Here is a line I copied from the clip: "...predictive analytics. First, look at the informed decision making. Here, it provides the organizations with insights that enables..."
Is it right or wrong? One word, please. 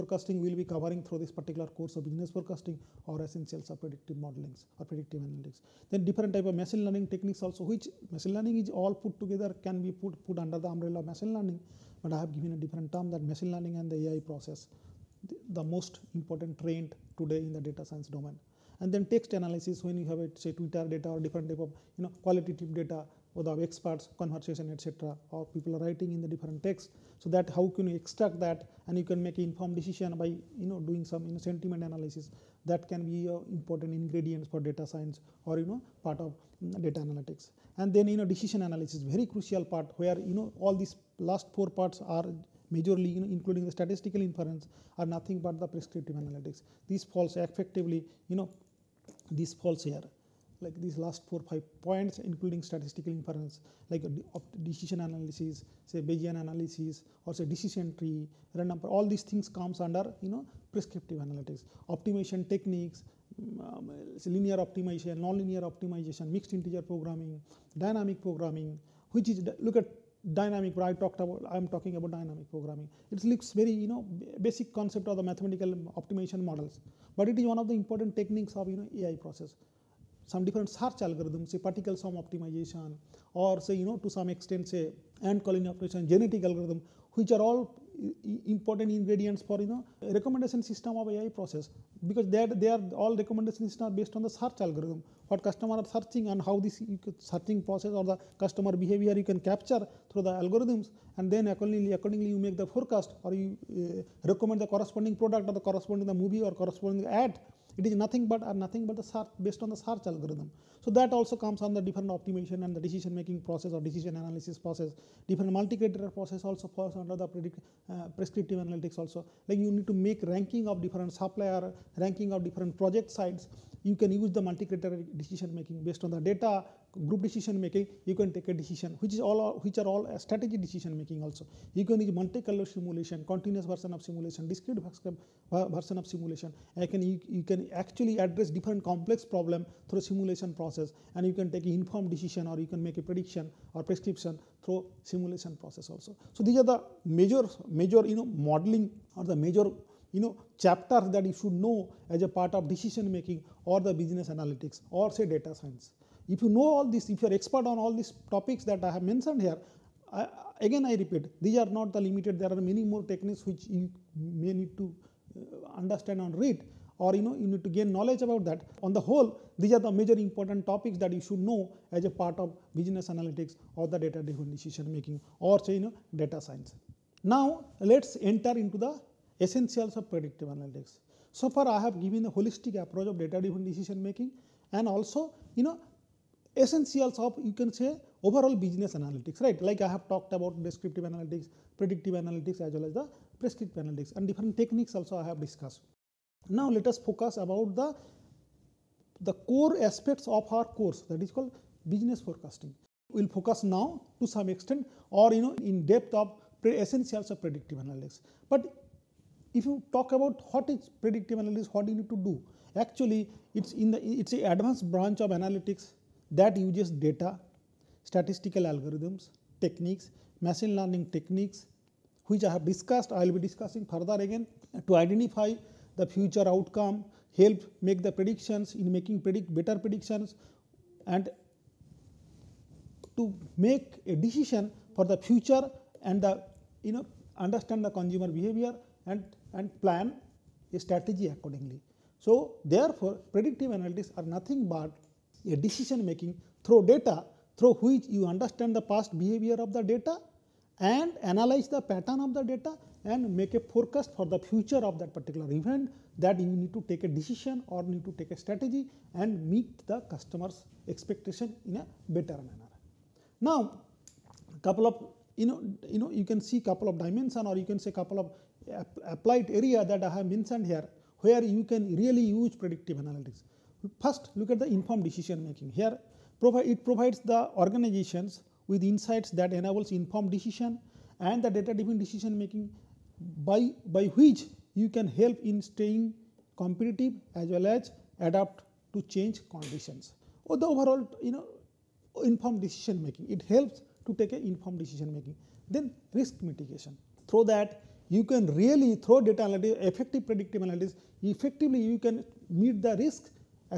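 right.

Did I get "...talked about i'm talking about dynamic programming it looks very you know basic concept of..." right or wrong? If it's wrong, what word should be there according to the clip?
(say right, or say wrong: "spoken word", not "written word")
right.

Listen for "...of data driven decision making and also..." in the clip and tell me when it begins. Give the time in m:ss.
3:03.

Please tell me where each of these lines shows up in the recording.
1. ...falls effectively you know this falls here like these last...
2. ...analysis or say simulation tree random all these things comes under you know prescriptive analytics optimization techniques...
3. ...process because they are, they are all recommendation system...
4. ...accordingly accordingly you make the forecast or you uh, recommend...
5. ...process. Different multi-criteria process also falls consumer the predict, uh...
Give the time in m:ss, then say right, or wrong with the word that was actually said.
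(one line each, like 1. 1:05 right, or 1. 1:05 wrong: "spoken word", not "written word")
1. 0:47 right
2. 0:56 wrong: "decision", not "simulation"
3. 1:31 right
4. 1:41 right
5. 1:54 wrong: "under", not "consumer".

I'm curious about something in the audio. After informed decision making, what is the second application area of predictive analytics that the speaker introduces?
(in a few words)
Risk mitigation.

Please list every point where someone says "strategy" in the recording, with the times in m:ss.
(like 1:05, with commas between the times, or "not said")
2:10, 4:00, 4:18.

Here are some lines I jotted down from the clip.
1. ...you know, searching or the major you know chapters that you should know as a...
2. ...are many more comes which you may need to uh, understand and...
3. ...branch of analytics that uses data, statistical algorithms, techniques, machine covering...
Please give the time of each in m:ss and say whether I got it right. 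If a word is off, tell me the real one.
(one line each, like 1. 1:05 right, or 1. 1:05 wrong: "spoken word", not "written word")
1. 2:28 wrong: "modeling", not "searching"
2. 2:42 wrong: "techniques", not "comes"
3. 3:34 wrong: "learning", not "covering".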